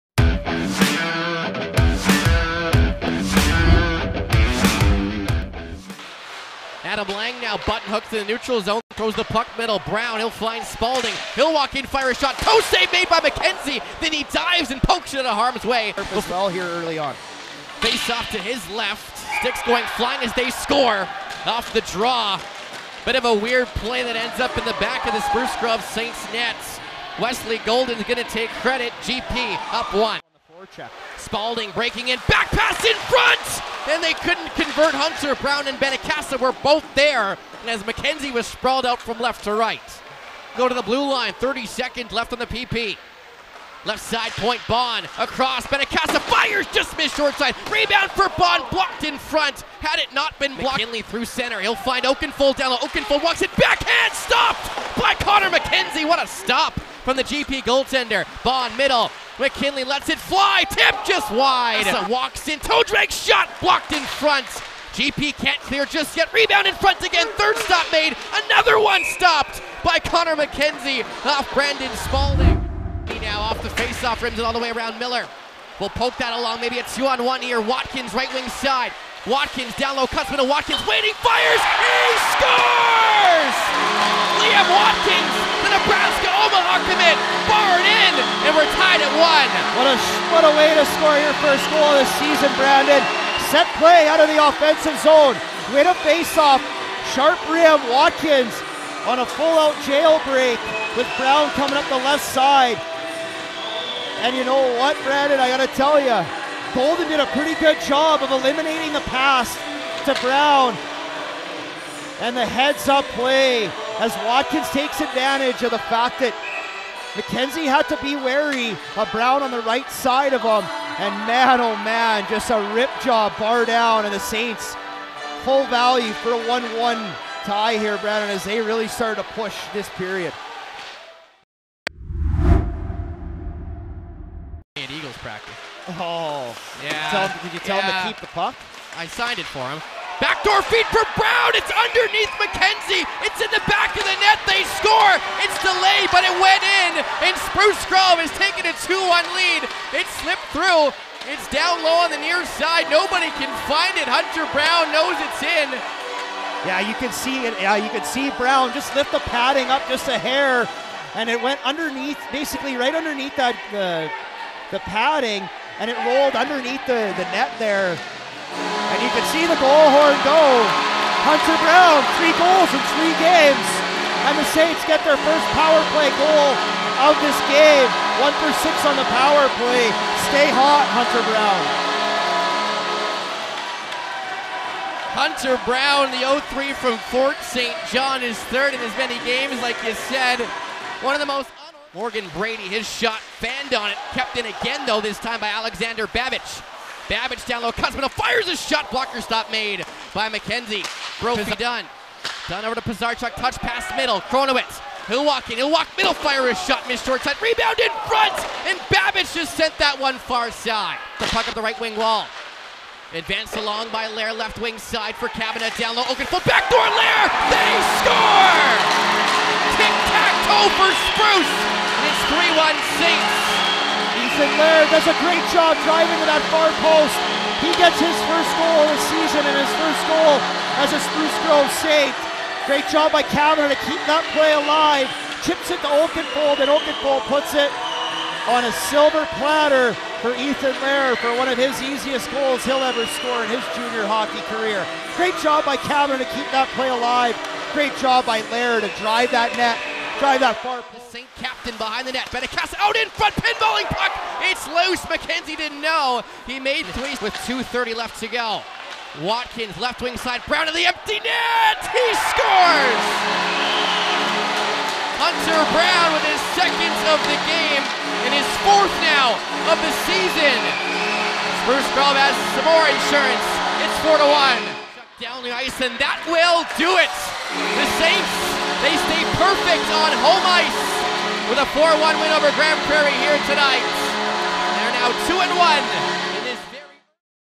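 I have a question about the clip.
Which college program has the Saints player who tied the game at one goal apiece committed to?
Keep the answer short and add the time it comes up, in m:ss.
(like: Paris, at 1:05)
Nebraska Omaha, at 1:25.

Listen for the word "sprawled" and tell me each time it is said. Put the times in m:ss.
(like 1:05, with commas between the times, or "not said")
0:38.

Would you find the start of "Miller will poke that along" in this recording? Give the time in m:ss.
1:14.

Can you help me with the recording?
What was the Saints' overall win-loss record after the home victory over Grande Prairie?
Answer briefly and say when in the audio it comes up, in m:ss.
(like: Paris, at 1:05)
2 and 1, at 4:45.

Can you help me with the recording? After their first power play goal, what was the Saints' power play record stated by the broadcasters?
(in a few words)
1 for 6.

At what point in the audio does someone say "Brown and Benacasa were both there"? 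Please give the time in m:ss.
0:35.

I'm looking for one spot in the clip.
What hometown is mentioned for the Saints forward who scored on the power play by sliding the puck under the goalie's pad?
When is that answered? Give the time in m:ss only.
3:07.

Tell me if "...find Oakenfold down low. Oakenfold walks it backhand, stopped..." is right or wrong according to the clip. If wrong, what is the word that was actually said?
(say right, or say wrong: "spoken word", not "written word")
right.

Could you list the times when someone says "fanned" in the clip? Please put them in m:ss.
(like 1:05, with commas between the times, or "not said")
3:13.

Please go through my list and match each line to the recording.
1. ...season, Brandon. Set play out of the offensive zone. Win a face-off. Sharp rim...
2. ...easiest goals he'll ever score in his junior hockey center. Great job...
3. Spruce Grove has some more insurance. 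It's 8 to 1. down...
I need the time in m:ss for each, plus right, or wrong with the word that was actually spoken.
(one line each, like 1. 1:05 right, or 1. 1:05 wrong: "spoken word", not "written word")
1. 1:32 right
2. 4:01 wrong: "career", not "center"
3. 4:31 wrong: "4", not "8".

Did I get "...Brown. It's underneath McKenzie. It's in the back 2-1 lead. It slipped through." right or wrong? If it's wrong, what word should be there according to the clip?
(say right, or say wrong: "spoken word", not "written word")
right.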